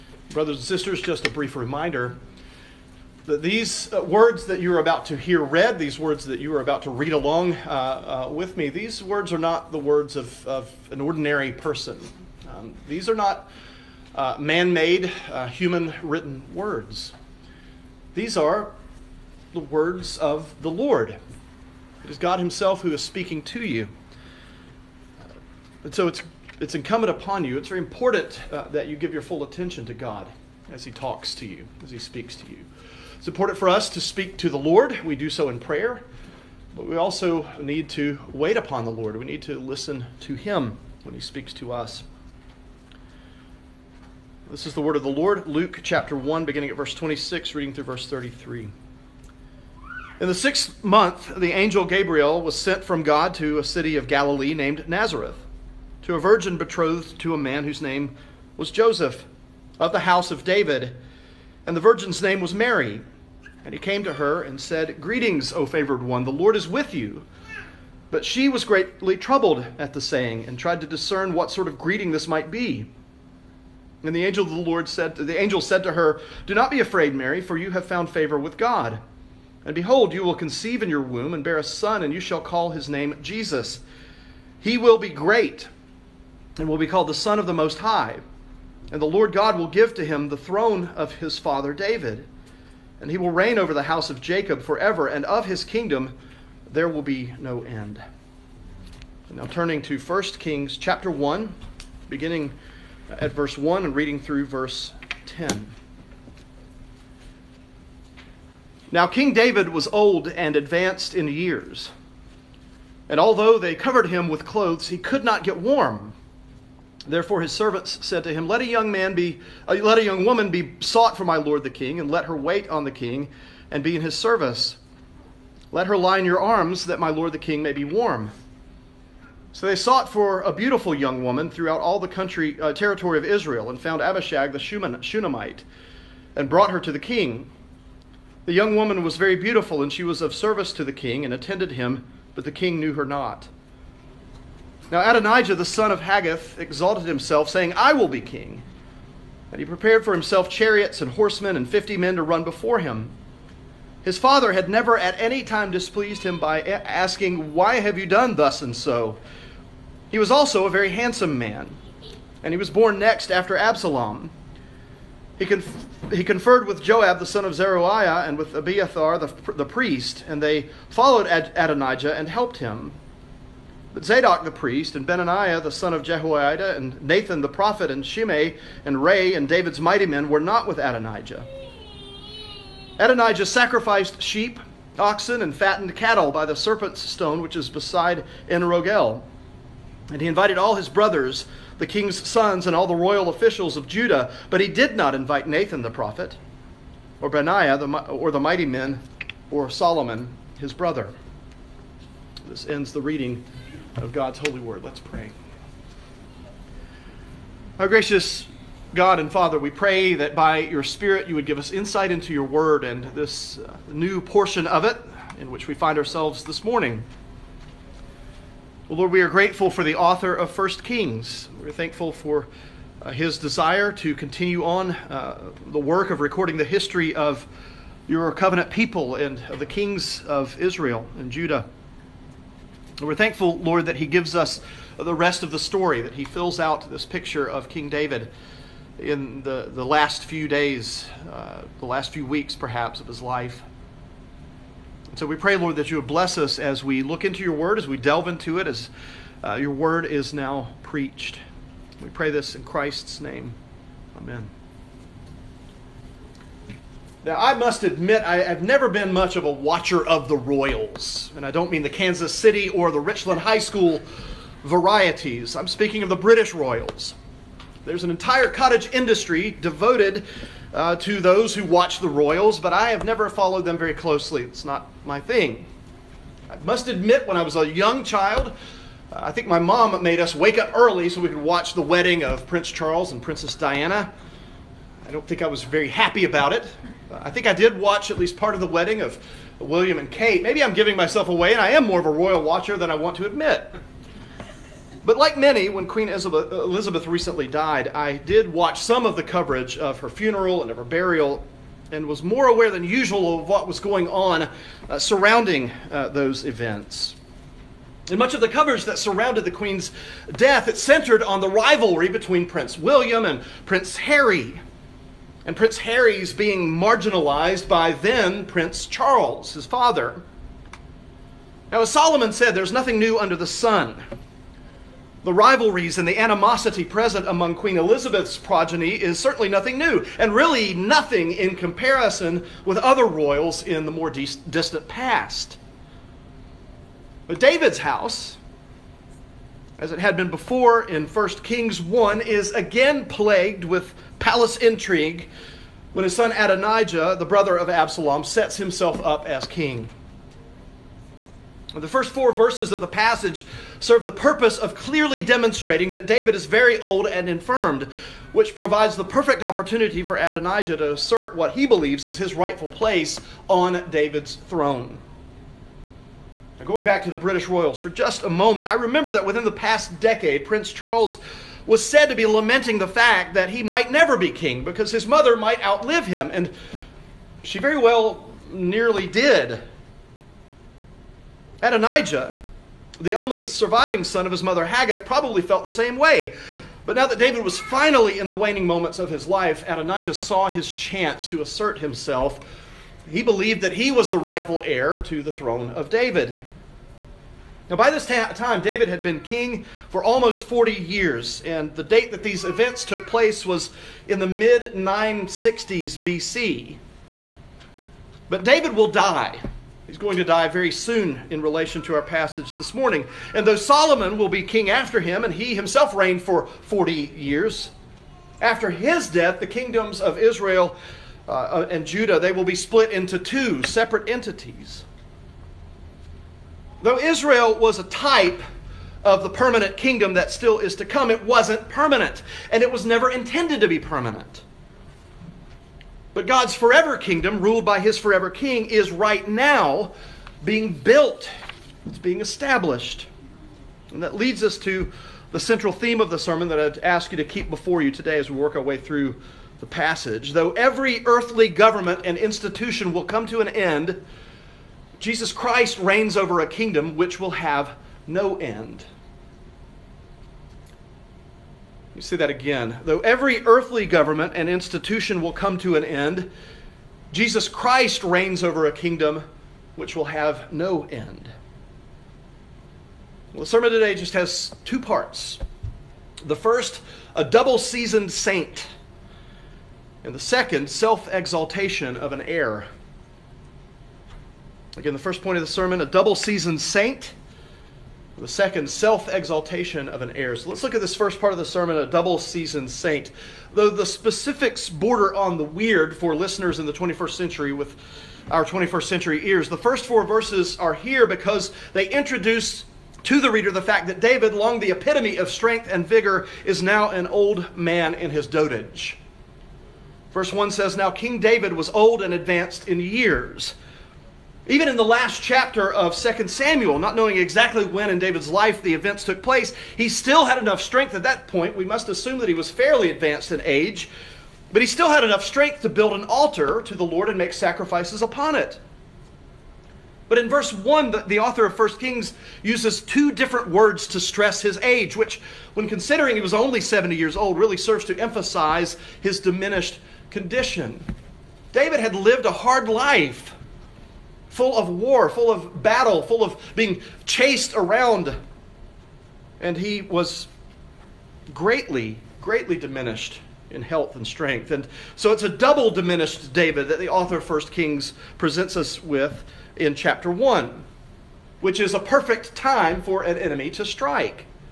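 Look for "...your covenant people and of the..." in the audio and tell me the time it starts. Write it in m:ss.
3:48.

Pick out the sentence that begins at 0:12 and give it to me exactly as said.
Um, these are not uh, man made, uh, human written words.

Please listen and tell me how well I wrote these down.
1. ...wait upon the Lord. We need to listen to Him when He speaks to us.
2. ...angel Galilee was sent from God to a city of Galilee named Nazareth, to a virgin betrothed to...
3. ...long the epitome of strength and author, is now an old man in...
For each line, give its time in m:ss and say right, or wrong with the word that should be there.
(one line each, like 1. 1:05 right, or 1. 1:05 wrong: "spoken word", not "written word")
1. 0:38 right
2. 0:51 wrong: "Gabriel", not "Galilee"
3. 8:24 wrong: "vigor", not "author".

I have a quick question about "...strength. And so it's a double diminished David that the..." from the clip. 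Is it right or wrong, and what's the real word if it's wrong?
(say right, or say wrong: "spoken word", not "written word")
right.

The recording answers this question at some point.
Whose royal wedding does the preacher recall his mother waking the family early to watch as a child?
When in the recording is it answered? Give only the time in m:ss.
4:42.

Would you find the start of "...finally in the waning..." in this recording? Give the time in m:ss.
6:27.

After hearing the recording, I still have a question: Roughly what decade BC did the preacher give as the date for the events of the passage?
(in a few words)
960s BC.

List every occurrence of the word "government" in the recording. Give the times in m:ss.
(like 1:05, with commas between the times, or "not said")
7:31, 7:43.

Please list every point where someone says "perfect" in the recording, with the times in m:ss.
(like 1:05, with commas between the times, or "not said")
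5:59, 9:21.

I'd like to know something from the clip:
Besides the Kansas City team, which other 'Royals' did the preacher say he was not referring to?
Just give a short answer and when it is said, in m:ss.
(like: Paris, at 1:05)
Richland High School, at 4:22.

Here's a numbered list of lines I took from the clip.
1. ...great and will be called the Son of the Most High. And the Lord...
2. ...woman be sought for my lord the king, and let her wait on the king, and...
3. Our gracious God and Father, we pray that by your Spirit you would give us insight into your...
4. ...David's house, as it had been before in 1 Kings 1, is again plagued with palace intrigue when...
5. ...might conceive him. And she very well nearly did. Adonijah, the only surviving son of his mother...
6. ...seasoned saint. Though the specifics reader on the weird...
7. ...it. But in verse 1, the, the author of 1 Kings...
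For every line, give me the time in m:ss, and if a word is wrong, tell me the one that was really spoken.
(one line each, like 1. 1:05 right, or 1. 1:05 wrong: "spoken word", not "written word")
1. 1:25 right
2. 2:00 right
3. 3:27 right
4. 5:37 right
5. 6:15 wrong: "outlive", not "conceive"
6. 8:12 wrong: "border", not "reader"
7. 8:48 right.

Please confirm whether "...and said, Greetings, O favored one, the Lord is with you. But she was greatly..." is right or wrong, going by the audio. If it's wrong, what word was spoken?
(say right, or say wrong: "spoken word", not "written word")
right.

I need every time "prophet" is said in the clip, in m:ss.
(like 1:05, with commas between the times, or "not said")
2:57, 3:15.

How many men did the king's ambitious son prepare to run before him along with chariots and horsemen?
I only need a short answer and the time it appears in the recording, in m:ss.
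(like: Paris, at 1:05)
50, at 2:31.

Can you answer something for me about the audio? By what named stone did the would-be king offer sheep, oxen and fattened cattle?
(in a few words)
the serpent's stone.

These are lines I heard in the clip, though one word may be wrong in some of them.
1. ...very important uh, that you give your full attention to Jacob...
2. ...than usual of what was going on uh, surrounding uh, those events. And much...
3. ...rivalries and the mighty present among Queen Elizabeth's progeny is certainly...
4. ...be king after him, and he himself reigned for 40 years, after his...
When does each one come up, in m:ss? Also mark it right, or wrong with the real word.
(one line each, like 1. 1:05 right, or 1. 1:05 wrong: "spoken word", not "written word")
1. 0:27 wrong: "God", not "Jacob"
2. 5:02 right
3. 5:25 wrong: "animosity", not "mighty"
4. 6:54 right.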